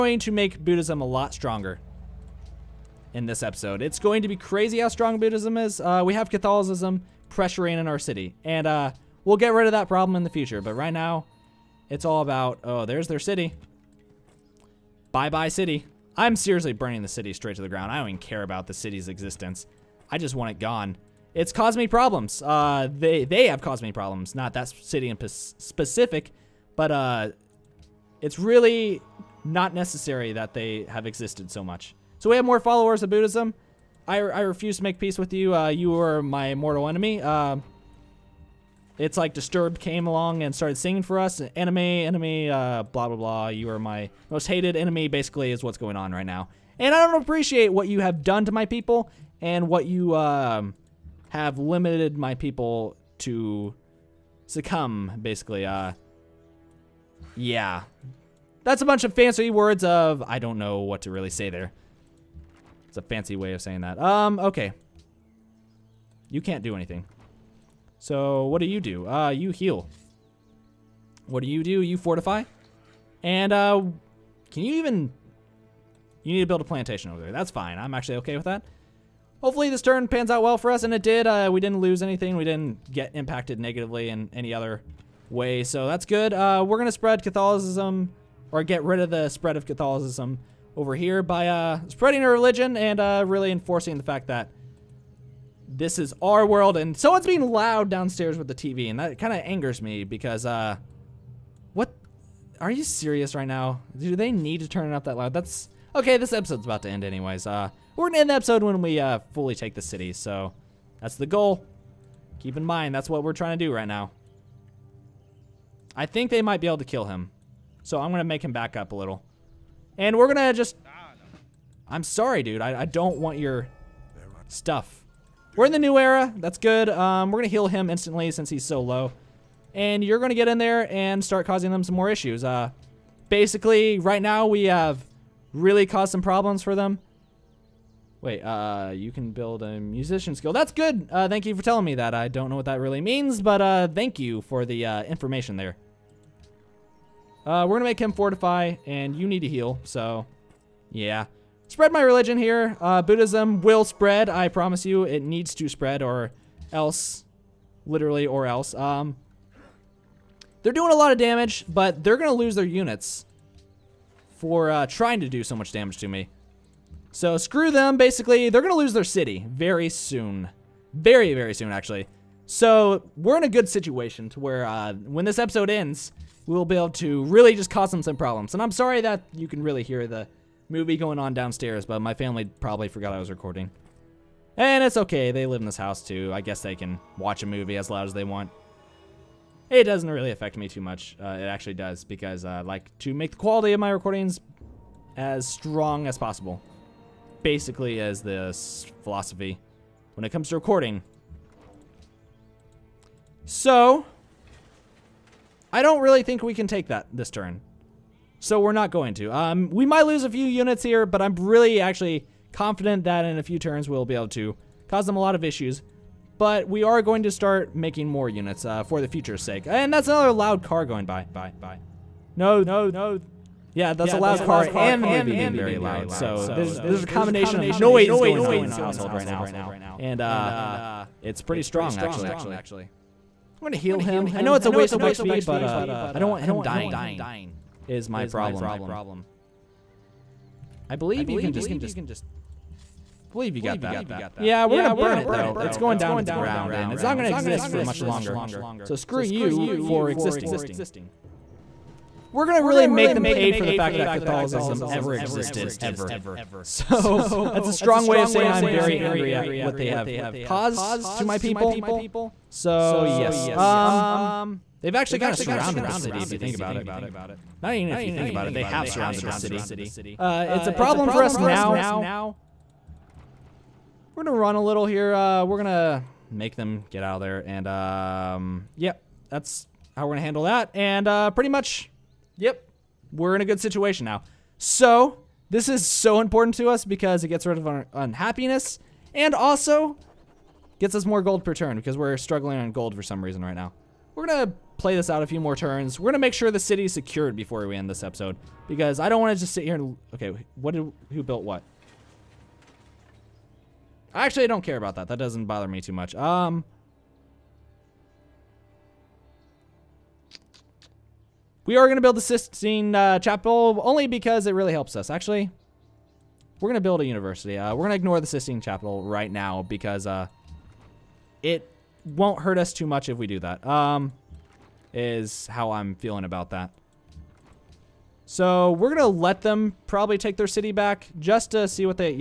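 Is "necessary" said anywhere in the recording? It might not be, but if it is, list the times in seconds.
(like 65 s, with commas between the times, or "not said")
29 s.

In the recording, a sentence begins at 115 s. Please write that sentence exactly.
I think they might be able to kill him, so I'm gonna make him back up a little.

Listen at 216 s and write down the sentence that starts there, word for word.
But we are going to start making more units uh, for the future's sake.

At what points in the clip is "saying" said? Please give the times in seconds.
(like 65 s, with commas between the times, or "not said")
63 s, 258 s.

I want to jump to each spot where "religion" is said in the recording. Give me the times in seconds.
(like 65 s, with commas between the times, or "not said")
92 s, 152 s.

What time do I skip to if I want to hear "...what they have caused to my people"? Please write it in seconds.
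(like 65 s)
259 s.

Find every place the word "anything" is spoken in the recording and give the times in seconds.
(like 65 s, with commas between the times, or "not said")
66 s, 82 s.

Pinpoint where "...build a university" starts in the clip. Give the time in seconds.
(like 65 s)
316 s.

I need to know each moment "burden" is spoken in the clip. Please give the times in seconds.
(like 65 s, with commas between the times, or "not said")
not said.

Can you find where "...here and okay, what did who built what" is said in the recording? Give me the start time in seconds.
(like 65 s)
299 s.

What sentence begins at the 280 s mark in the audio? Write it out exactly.
And uh, pretty much, yep, we're in a good situation now.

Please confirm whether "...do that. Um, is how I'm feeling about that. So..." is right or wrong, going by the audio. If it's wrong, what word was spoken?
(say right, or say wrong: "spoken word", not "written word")
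right.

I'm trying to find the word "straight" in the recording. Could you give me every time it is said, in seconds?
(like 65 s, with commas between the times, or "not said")
17 s.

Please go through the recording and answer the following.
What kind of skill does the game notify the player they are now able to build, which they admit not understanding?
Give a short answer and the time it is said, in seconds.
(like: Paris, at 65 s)
musician skill, at 139 s.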